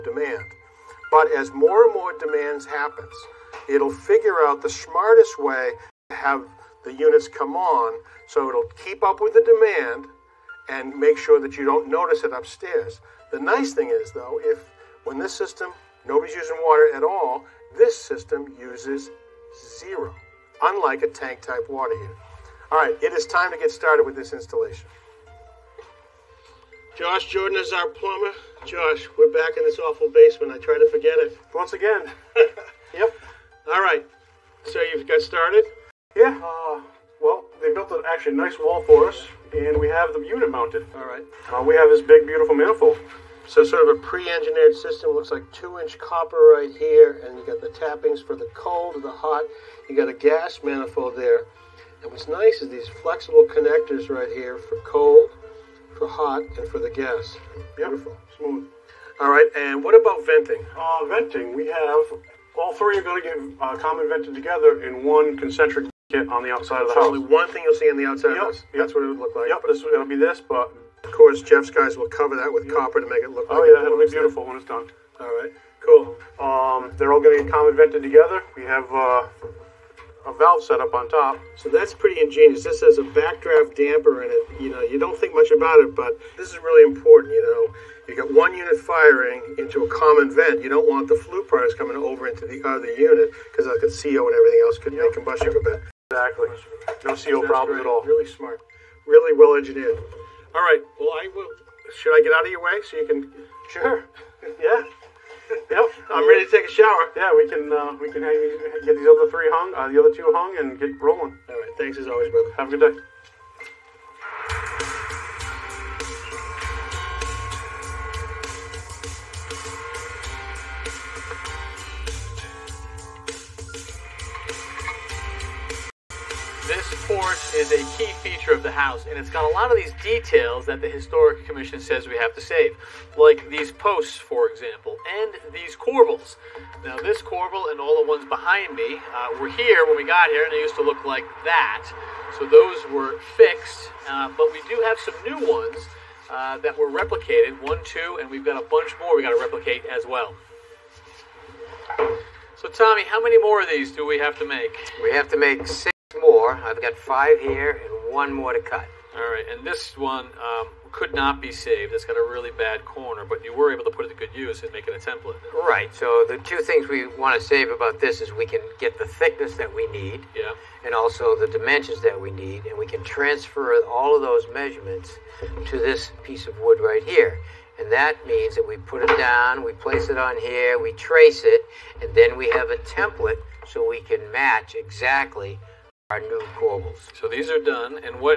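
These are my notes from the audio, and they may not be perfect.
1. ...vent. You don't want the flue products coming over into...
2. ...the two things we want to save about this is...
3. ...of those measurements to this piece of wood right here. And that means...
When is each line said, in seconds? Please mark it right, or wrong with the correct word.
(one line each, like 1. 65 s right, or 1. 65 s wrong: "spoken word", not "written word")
1. 90 s right
2. 166 s right
3. 174 s right.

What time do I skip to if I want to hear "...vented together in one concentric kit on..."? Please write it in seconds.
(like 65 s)
64 s.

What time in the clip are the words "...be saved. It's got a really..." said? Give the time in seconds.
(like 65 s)
161 s.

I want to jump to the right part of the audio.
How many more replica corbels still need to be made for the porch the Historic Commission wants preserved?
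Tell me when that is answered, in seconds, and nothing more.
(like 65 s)
155 s.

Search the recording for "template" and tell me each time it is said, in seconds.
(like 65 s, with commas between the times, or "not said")
165 s, 182 s.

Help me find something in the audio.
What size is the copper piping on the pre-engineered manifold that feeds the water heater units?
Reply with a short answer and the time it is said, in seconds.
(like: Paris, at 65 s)
2-inch, at 45 s.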